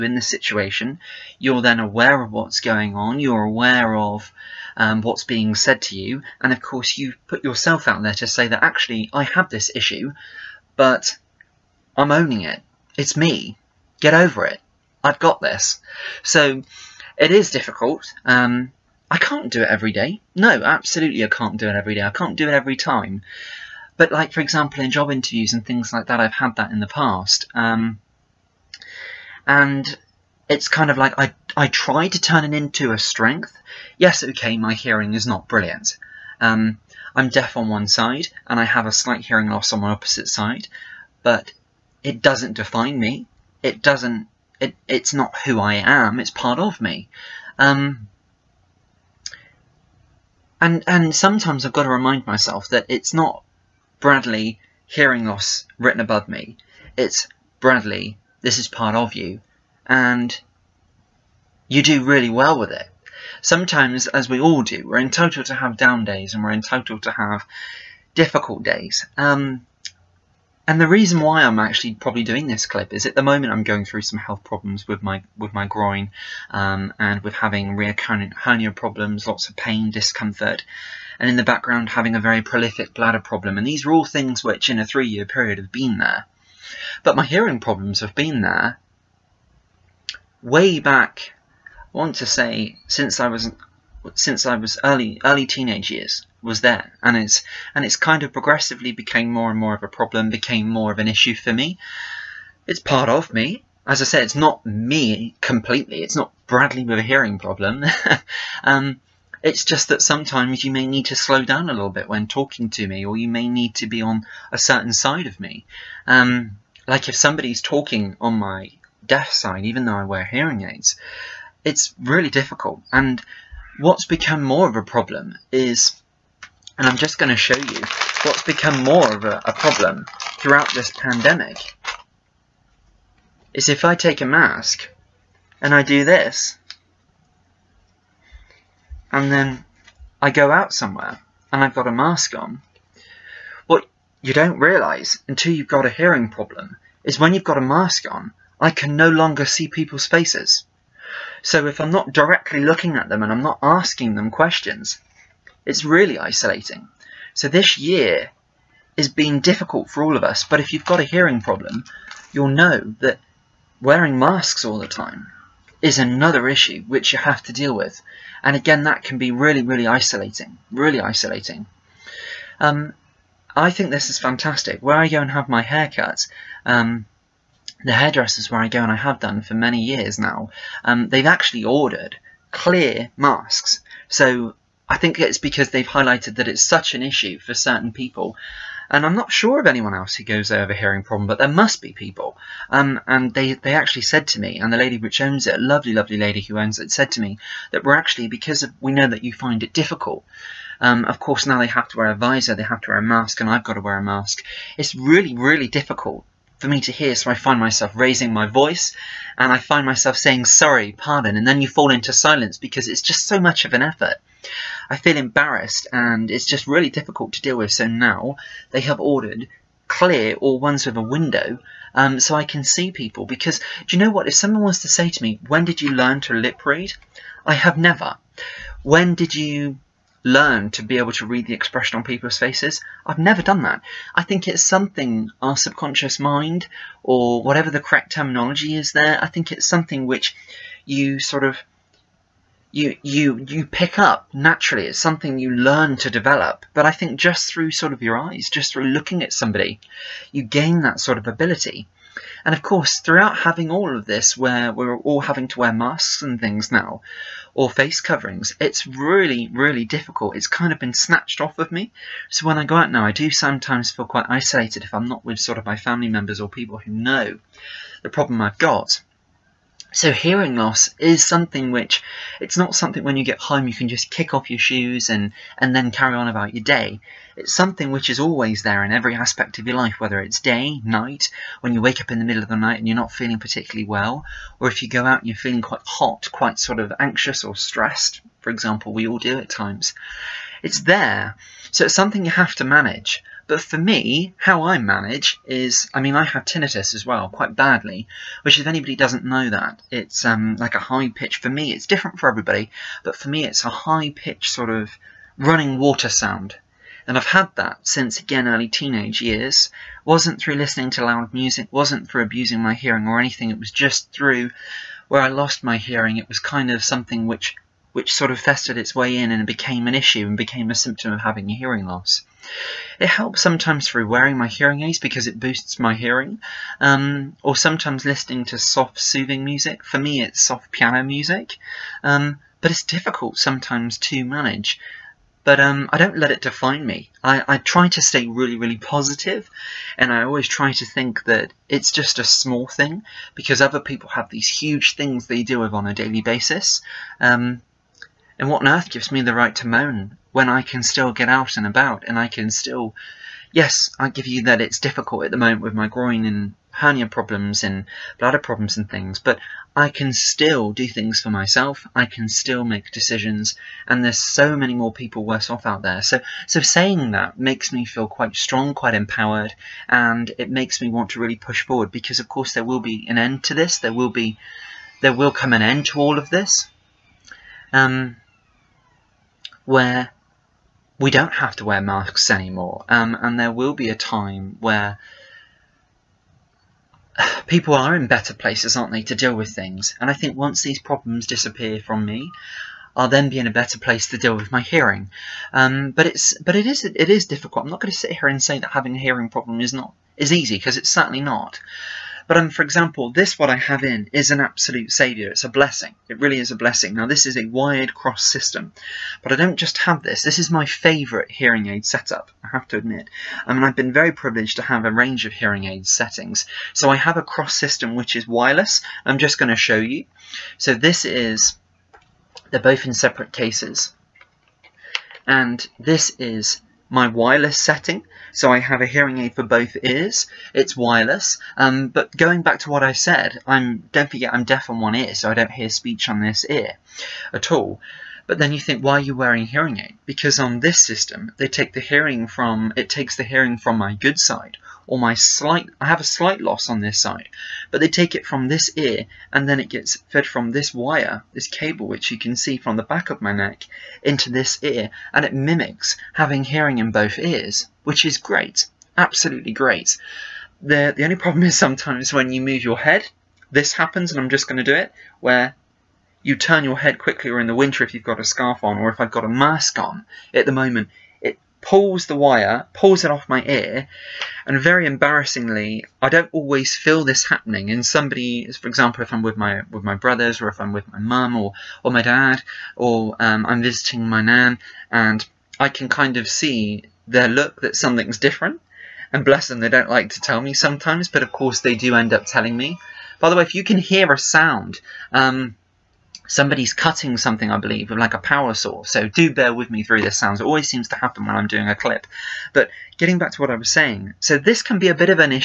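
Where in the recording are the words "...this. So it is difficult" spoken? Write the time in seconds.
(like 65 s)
15 s.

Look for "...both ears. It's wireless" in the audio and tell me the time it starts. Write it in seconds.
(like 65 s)
429 s.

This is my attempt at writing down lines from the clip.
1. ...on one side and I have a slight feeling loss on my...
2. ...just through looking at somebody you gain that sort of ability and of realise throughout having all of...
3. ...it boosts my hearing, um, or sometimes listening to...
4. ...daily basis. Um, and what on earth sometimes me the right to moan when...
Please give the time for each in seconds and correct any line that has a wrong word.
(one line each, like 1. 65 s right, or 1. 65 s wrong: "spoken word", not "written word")
1. 37 s wrong: "hearing", not "feeling"
2. 248 s wrong: "course", not "realise"
3. 325 s right
4. 345 s wrong: "gives", not "sometimes".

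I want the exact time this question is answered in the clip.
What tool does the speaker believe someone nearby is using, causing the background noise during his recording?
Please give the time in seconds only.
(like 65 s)
498 s.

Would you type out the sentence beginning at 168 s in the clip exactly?
And again, that can be really, really isolating, really isolating.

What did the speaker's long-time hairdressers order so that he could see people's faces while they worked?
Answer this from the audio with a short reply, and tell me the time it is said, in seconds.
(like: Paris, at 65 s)
clear masks, at 182 s.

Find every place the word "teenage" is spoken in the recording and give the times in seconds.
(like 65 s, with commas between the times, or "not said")
95 s, 308 s.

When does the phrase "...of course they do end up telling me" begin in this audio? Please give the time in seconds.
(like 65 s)
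491 s.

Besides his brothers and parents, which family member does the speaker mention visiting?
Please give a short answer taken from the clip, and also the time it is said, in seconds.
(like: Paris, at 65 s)
nan, at 484 s.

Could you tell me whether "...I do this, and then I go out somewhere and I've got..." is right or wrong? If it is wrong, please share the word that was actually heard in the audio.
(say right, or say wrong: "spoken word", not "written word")
right.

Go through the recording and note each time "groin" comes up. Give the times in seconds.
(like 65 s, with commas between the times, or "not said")
75 s, 355 s.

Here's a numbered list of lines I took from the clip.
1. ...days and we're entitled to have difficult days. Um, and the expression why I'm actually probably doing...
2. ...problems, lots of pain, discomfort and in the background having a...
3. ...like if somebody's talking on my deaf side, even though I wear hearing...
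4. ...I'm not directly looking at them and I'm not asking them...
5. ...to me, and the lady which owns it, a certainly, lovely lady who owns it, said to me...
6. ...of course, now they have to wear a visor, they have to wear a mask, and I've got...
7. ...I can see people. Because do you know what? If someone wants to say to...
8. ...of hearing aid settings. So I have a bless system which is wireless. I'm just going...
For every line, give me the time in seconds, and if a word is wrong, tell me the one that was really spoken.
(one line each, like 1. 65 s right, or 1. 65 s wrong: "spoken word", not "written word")
1. 66 s wrong: "reason", not "expression"
2. 78 s right
3. 116 s right
4. 151 s right
5. 194 s wrong: "lovely", not "certainly"
6. 201 s right
7. 222 s right
8. 415 s wrong: "cross", not "bless".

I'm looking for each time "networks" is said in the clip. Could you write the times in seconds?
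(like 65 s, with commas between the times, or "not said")
not said.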